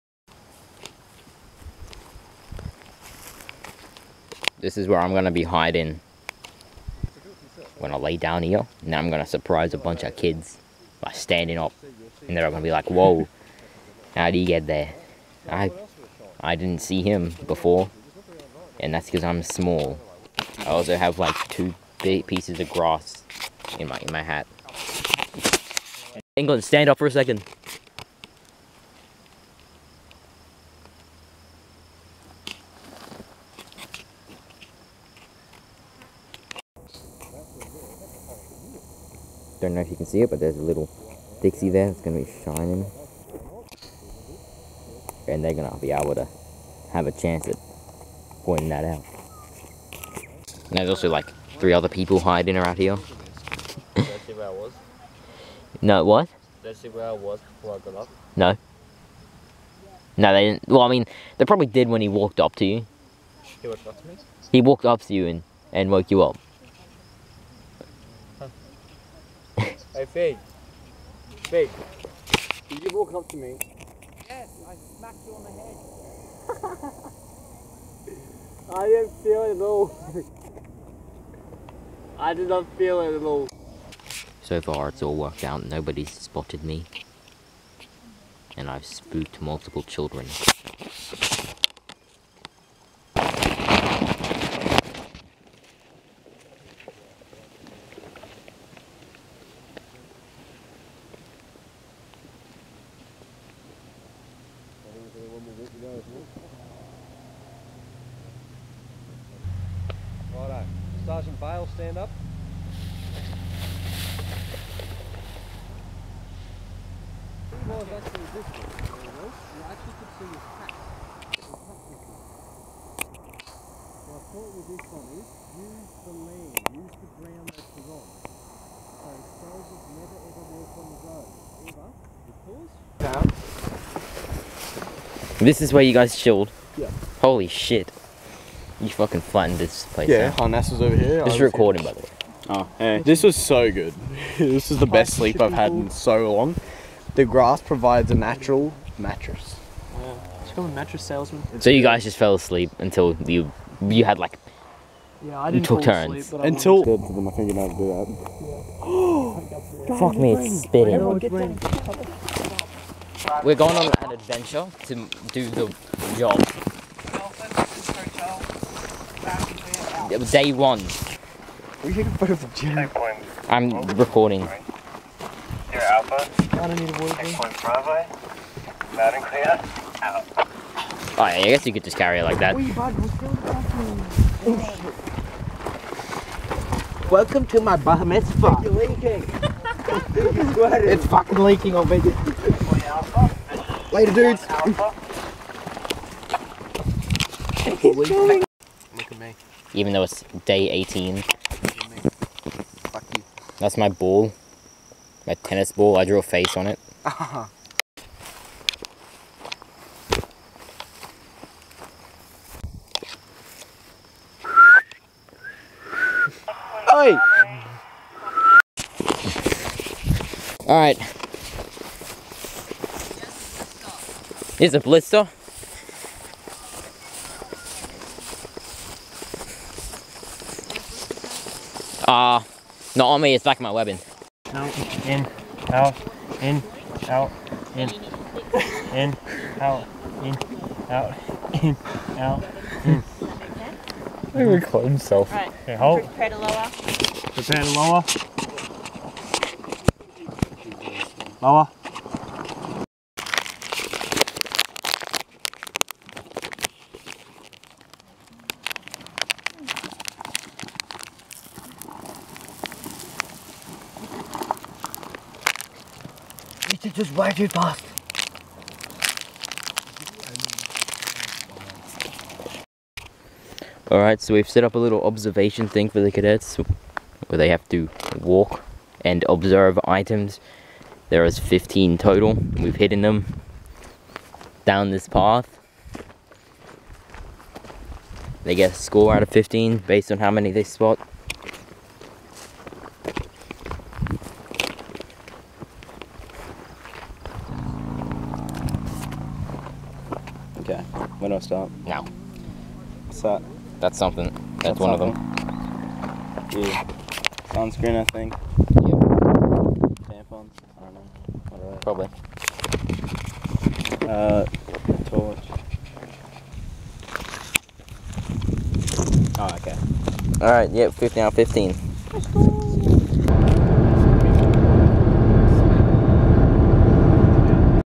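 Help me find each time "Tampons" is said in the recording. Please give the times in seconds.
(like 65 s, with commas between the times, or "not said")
310 s.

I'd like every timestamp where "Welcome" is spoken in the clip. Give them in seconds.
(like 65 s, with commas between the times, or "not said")
187 s.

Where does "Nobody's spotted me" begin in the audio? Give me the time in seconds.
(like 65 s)
85 s.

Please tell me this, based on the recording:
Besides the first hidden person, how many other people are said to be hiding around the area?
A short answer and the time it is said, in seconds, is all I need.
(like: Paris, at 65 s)
3, at 51 s.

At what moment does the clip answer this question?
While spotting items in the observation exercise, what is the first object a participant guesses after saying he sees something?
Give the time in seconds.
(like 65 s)
307 s.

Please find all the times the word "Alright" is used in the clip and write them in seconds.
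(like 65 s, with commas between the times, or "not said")
220 s, 273 s.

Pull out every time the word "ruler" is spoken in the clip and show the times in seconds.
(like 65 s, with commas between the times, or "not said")
not said.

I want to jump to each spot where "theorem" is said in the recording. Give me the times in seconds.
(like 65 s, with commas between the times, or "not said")
not said.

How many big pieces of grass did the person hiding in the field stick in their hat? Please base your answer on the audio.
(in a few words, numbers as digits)
2.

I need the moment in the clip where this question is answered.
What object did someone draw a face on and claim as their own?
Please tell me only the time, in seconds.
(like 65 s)
205 s.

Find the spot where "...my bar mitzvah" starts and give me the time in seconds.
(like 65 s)
187 s.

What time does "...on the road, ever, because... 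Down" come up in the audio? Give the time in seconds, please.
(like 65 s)
130 s.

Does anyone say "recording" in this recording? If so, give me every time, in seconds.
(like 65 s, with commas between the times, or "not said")
141 s, 173 s.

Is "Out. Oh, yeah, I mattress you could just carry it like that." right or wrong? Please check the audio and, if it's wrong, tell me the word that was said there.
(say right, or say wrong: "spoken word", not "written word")
wrong: "guess", not "mattress".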